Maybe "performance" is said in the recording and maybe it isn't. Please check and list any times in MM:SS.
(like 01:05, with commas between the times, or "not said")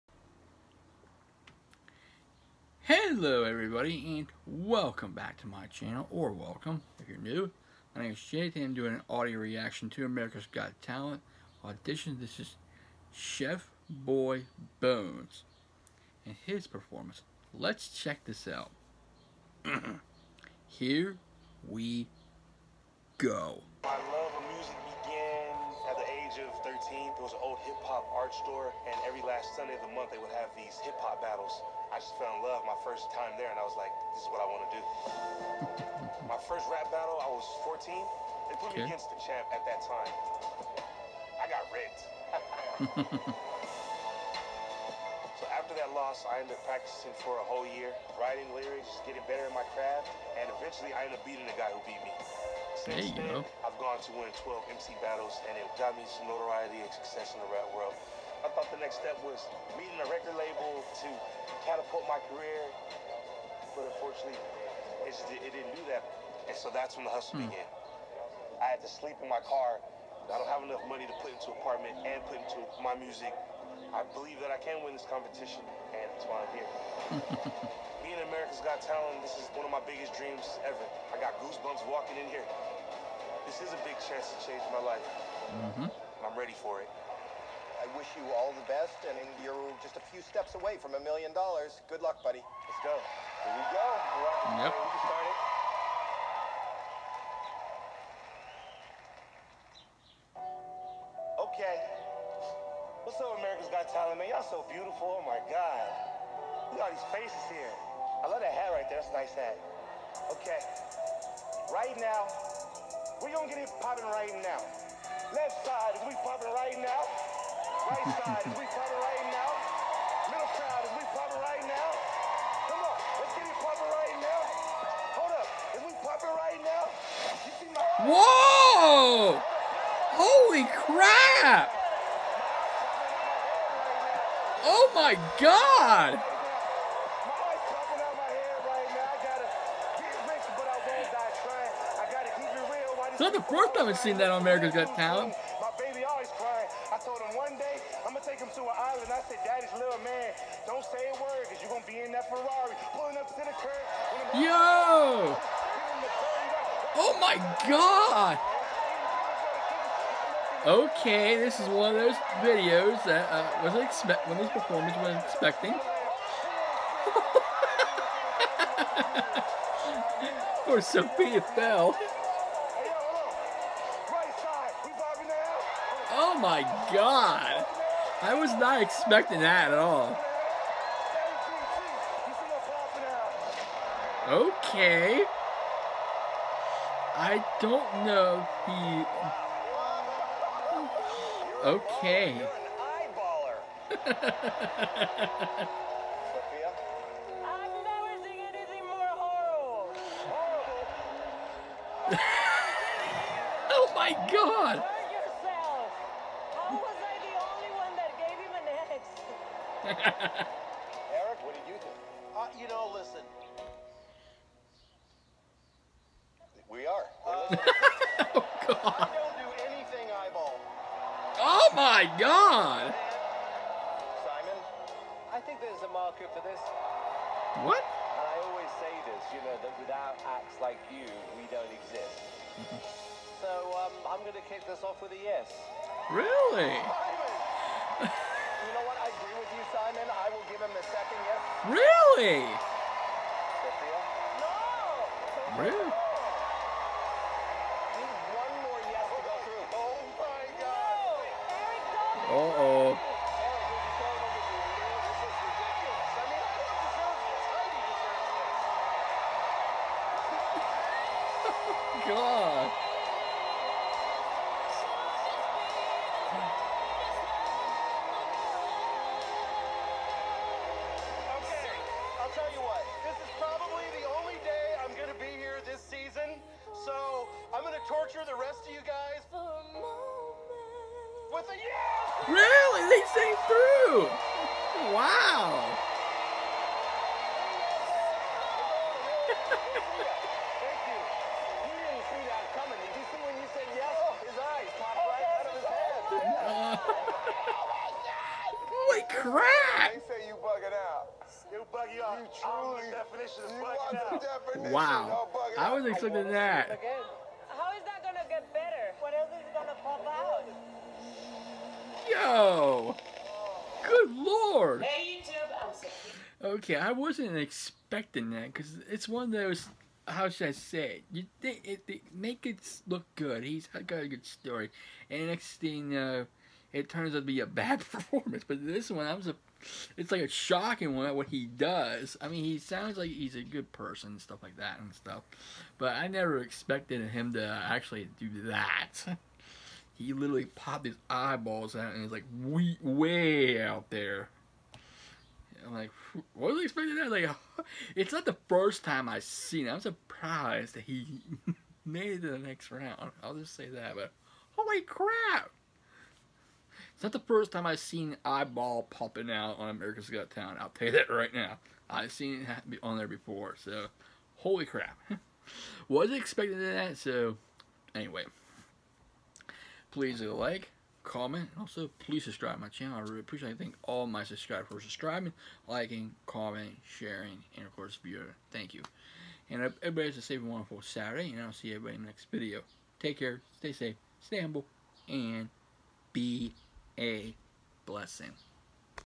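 00:16, 02:44, 05:27.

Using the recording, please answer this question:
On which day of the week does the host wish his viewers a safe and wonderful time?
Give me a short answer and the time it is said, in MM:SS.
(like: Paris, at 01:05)
Saturday, at 06:20.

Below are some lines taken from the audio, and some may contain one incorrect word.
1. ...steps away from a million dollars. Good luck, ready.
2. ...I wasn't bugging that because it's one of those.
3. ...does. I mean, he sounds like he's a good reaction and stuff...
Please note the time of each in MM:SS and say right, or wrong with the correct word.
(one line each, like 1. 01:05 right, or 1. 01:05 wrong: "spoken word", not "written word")
1. 01:30 wrong: "buddy", not "ready"
2. 05:16 wrong: "expecting", not "bugging"
3. 05:31 wrong: "person", not "reaction".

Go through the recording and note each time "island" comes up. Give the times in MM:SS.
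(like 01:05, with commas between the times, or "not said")
02:28.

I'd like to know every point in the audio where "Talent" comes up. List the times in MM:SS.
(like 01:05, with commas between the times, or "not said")
00:10, 01:18, 01:43, 02:24, 06:00.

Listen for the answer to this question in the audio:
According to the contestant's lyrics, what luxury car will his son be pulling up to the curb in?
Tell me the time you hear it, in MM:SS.
02:32.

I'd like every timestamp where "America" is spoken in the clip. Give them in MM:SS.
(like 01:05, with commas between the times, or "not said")
00:10, 01:18, 01:43, 02:24, 05:59.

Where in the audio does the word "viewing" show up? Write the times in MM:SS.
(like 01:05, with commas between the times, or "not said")
06:18.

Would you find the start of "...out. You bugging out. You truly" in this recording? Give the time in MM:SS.
05:00.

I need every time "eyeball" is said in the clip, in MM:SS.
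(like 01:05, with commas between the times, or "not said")
03:40, 05:41, 05:58.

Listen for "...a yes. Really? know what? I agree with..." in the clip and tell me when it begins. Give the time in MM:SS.
03:55.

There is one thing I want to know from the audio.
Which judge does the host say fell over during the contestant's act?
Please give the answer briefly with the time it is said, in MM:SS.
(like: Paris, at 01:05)
Sofia, at 02:50.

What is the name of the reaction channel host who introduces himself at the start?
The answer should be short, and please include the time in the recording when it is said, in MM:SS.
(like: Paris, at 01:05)
Jathan, at 00:08.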